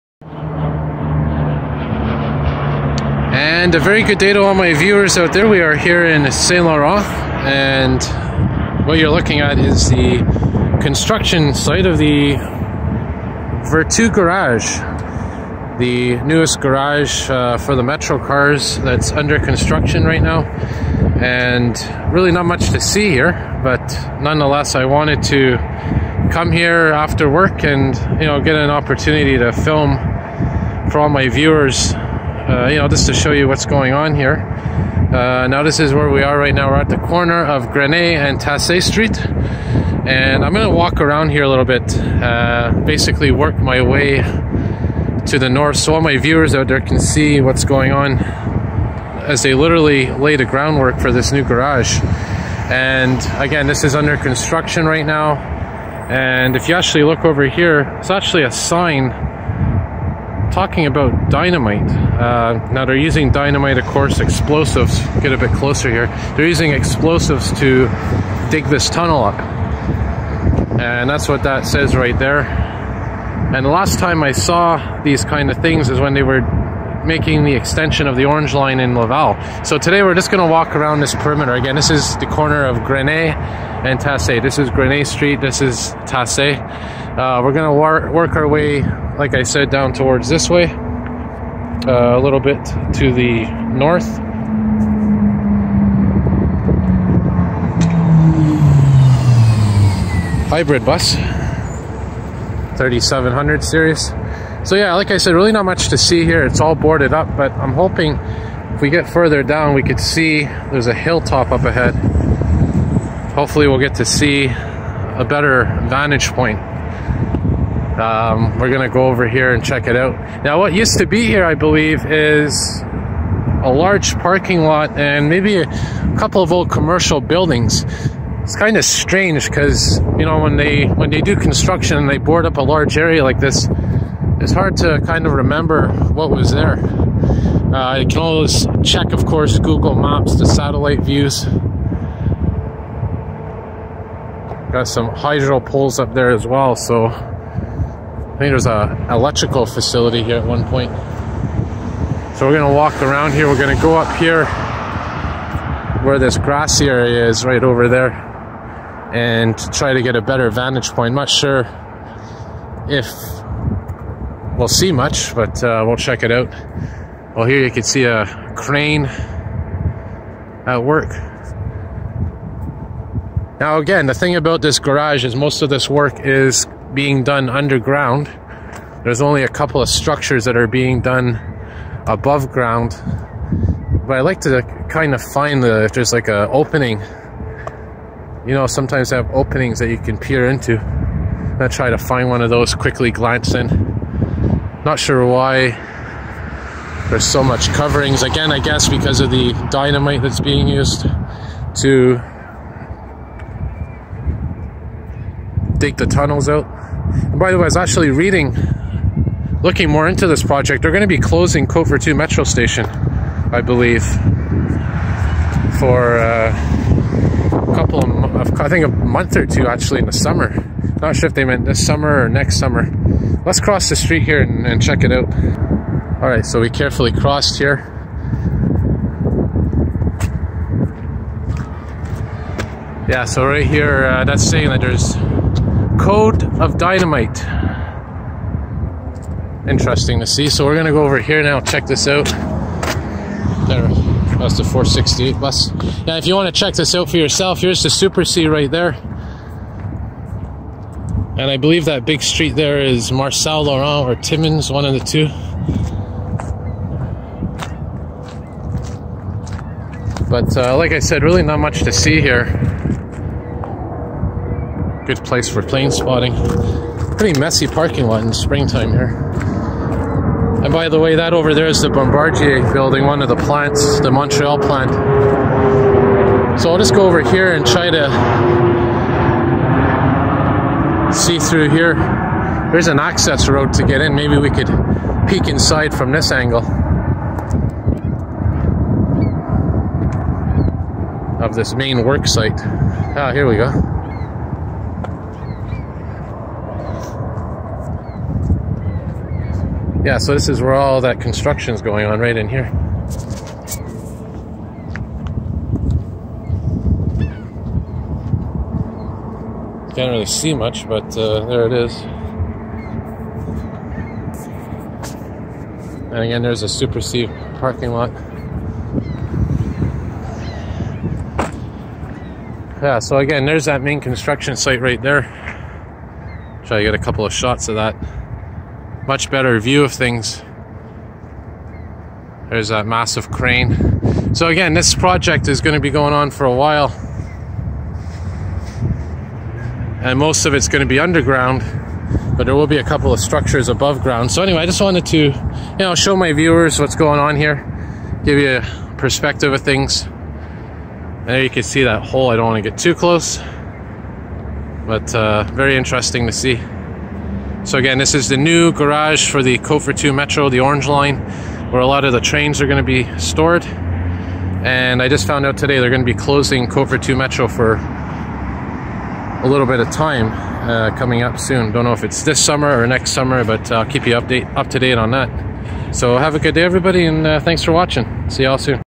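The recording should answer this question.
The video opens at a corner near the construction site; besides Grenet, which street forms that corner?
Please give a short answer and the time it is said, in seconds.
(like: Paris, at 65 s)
Tassé Street, at 38 s.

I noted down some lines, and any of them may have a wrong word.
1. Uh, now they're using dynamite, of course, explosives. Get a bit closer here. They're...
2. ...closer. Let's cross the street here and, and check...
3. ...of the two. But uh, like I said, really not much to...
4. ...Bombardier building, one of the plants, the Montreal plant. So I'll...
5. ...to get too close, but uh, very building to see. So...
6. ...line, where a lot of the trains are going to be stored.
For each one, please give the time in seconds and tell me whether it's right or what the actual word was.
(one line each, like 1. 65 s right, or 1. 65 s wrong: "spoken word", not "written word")
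1. 61 s right
2. 222 s wrong: "summer", not "closer"
3. 254 s right
4. 271 s right
5. 352 s wrong: "interesting", not "building"
6. 360 s right.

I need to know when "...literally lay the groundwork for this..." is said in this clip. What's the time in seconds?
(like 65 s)
49 s.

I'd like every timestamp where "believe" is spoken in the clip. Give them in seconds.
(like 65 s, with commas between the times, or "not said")
121 s, 213 s, 251 s.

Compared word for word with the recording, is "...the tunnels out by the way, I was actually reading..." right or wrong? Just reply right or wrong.
right.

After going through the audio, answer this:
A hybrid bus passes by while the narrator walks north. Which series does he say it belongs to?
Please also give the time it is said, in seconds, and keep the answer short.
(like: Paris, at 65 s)
3700 series, at 102 s.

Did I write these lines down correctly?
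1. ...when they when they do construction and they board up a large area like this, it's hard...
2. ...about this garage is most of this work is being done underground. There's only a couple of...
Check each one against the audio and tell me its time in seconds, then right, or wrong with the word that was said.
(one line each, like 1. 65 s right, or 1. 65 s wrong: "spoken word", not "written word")
1. 130 s right
2. 174 s right.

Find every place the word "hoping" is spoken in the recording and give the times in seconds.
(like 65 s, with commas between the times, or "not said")
107 s.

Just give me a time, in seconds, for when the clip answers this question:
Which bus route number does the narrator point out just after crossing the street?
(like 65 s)
244 s.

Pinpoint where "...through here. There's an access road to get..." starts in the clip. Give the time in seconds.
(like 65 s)
281 s.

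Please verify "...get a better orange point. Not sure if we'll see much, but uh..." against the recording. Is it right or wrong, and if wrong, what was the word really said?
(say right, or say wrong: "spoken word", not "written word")
wrong: "vantage", not "orange".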